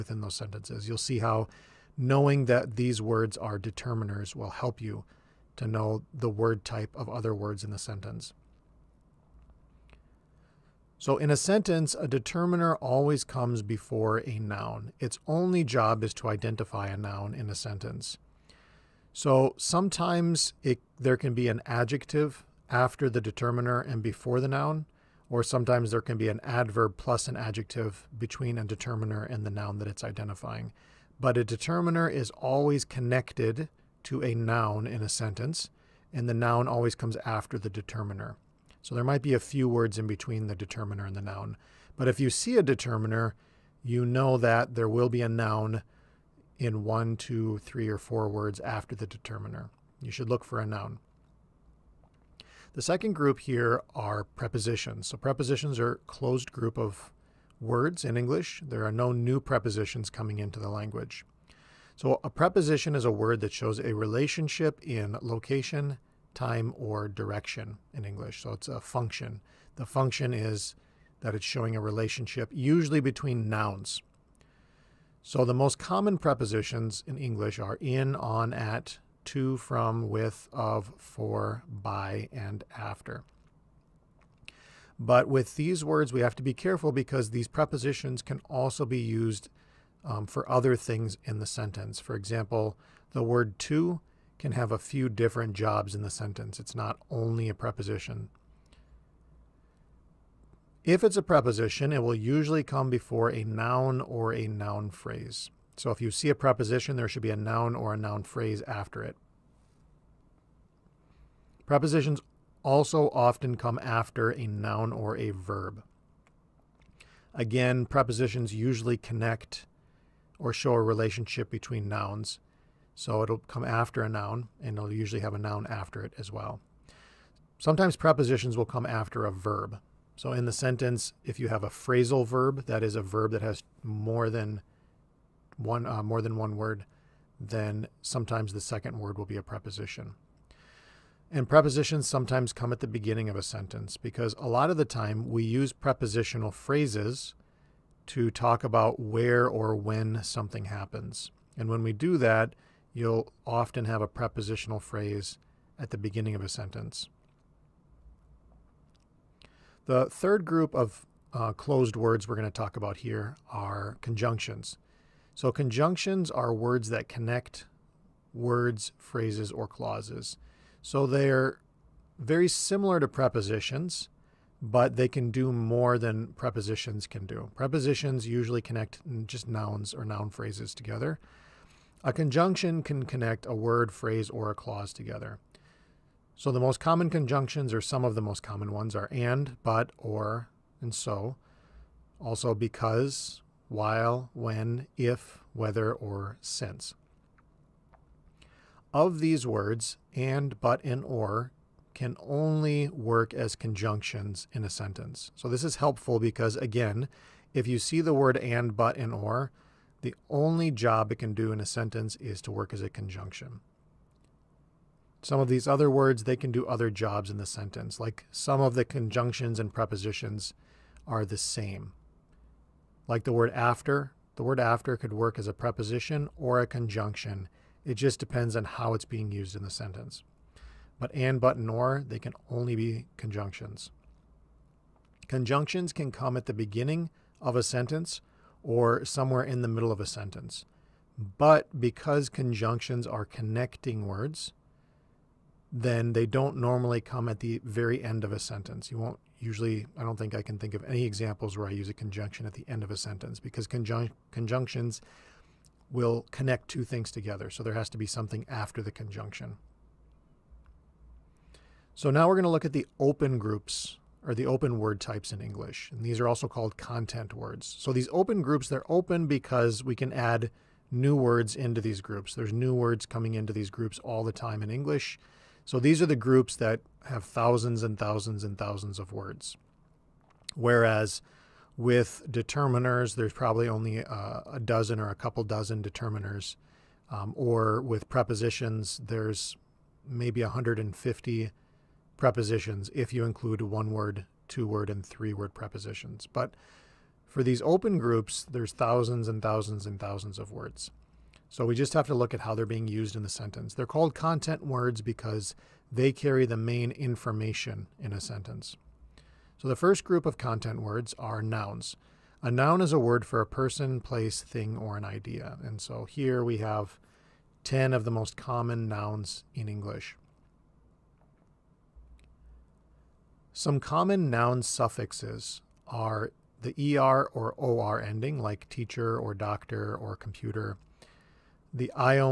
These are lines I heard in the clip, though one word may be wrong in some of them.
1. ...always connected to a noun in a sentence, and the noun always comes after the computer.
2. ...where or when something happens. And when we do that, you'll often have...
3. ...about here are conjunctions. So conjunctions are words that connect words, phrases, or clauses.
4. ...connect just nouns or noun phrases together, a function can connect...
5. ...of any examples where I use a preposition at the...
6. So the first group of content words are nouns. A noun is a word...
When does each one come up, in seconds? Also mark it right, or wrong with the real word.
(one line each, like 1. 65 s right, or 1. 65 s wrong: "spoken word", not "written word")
1. 32 s wrong: "determiner", not "computer"
2. 149 s right
3. 162 s right
4. 178 s wrong: "conjunction", not "function"
5. 250 s wrong: "conjunction", not "preposition"
6. 309 s right.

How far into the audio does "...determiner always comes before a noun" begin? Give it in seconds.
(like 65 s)
12 s.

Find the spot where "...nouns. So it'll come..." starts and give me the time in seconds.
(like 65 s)
121 s.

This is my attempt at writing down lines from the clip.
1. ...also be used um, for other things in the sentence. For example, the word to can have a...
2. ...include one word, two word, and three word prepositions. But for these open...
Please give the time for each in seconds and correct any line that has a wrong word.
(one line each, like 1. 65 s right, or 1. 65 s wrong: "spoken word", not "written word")
1. 88 s right
2. 293 s right.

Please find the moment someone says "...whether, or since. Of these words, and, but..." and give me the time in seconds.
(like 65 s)
195 s.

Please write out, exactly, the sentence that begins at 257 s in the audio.
So there has to be something after the conjunction.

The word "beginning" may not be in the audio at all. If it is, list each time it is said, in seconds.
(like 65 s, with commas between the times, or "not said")
142 s, 155 s, 236 s.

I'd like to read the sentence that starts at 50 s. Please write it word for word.
You should look for a noun.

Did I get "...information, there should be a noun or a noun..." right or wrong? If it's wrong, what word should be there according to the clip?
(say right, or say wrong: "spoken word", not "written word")
wrong: "preposition", not "information".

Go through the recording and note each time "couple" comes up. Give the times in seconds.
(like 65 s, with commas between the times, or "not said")
285 s.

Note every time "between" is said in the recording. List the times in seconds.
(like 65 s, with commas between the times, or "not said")
28 s, 40 s, 73 s, 121 s.